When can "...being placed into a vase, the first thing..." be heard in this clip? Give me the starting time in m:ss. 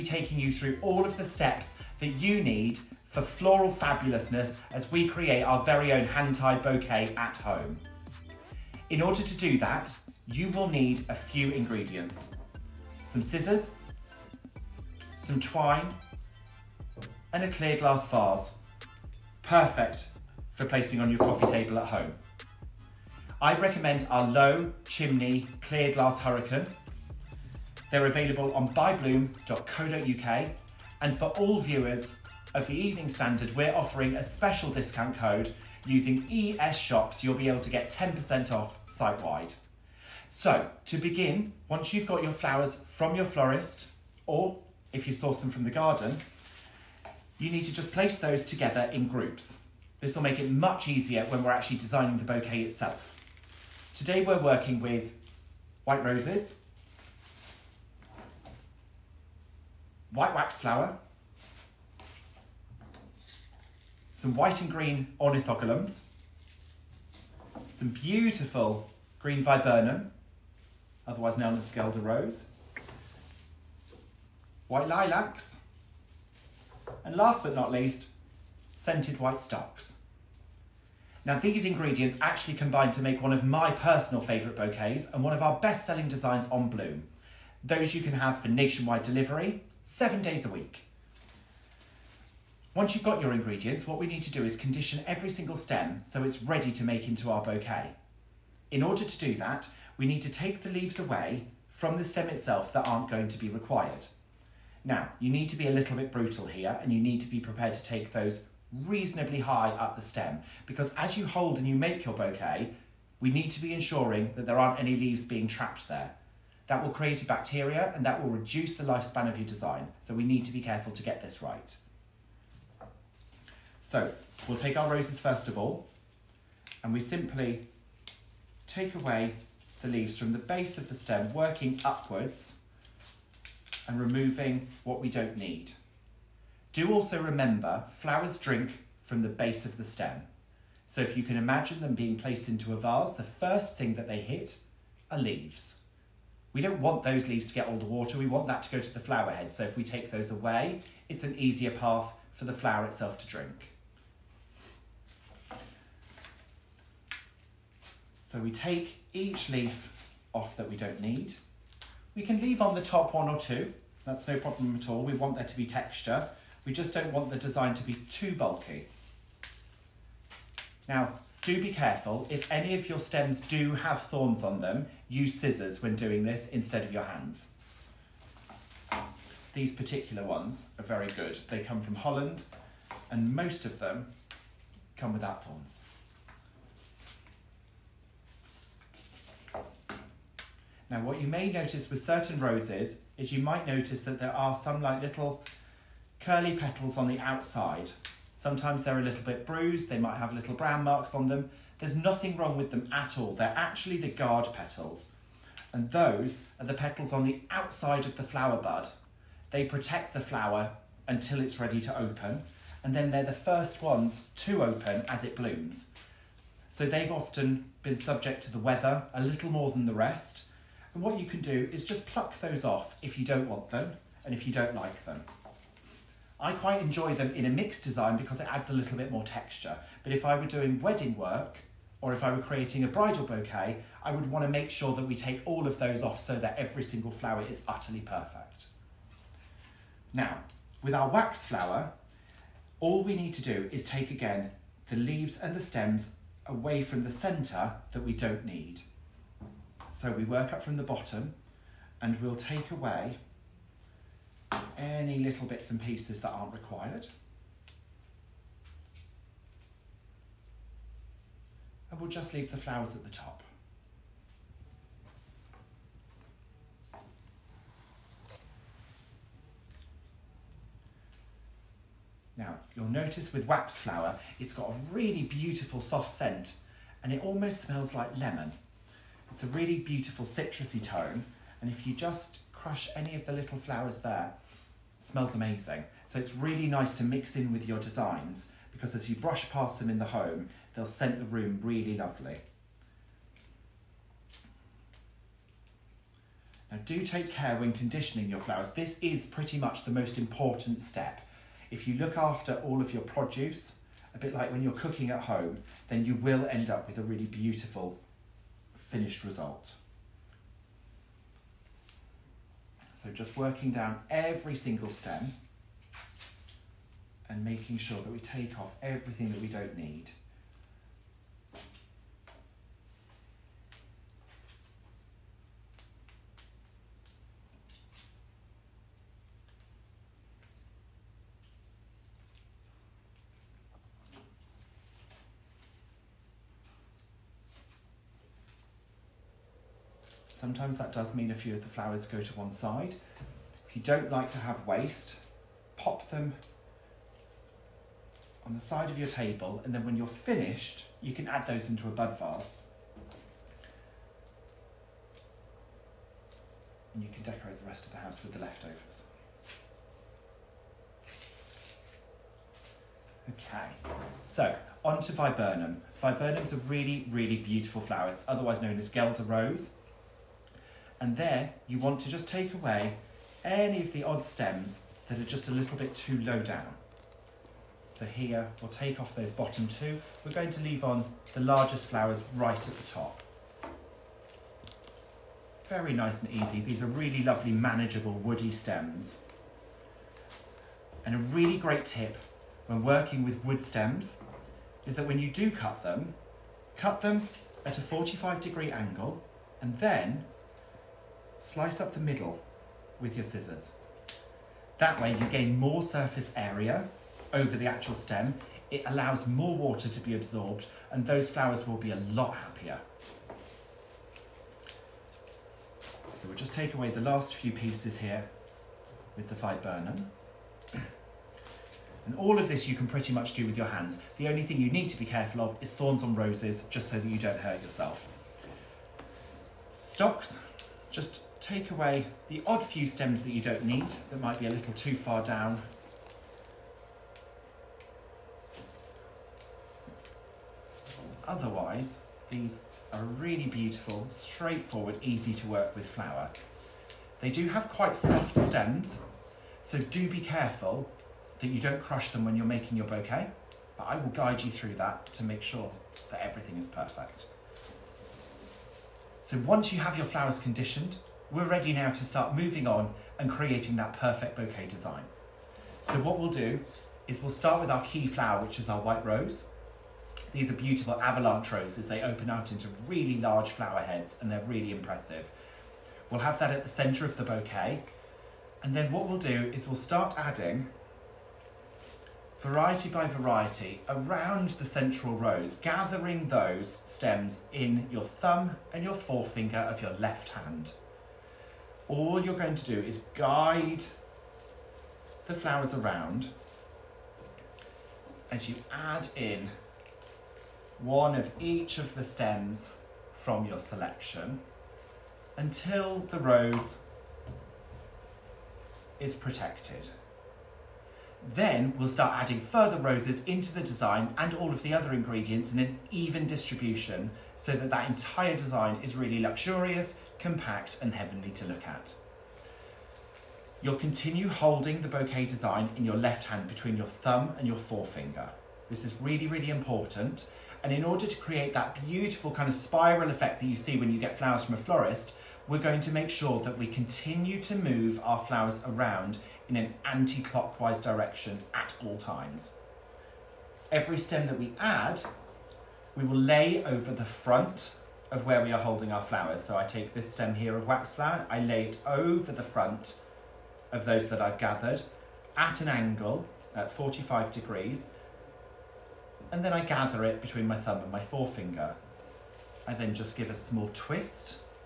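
2:21.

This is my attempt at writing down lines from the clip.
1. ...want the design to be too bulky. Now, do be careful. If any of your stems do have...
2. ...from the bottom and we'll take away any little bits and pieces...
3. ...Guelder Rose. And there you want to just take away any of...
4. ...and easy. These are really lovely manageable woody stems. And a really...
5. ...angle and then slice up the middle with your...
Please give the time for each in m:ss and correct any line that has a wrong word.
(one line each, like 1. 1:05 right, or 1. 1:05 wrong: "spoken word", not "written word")
1. 2:47 right
2. 4:10 right
3. 6:08 right
4. 6:26 right
5. 6:38 right.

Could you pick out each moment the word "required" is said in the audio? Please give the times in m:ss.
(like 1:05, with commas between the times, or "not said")
1:43, 4:16.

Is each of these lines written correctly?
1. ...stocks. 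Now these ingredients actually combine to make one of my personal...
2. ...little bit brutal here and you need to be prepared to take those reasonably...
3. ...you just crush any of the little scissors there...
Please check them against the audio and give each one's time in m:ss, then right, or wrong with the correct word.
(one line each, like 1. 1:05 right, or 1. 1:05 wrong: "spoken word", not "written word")
1. 1:19 right
2. 1:45 right
3. 4:41 wrong: "flowers", not "scissors".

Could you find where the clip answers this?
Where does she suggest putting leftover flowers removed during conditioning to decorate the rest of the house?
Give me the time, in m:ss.
5:51.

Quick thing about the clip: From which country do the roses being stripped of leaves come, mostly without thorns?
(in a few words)
Holland.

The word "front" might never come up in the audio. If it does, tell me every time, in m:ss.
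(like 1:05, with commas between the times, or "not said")
9:07, 9:12.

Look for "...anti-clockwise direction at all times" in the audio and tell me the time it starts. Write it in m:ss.
8:59.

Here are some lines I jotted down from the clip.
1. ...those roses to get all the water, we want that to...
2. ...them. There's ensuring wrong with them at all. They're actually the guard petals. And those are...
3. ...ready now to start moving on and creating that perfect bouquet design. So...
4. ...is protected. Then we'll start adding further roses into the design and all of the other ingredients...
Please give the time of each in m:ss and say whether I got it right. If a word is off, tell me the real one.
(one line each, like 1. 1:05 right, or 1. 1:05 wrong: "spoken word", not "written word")
1. 2:27 wrong: "leaves", not "roses"
2. 3:21 wrong: "nothing", not "ensuring"
3. 7:41 right
4. 8:28 right.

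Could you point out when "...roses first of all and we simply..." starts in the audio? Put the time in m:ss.
2:04.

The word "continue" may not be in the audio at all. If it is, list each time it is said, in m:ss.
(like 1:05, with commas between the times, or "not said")
8:43, 8:56.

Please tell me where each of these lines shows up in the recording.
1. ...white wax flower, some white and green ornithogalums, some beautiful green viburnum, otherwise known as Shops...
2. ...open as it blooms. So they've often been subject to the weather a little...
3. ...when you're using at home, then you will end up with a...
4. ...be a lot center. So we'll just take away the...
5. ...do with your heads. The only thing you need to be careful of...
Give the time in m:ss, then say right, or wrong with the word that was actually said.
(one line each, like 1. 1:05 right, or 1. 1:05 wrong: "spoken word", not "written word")
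1. 1:00 wrong: "Guelder", not "Shops"
2. 3:34 right
3. 5:04 wrong: "cooking", not "using"
4. 6:51 wrong: "happier", not "center"
5. 7:03 wrong: "hands", not "heads".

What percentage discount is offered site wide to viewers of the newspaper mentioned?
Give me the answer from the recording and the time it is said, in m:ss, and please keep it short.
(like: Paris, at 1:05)
10%, at 0:37.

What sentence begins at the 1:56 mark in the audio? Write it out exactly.
That will create a bacteria and that will reduce the lifespan of your design.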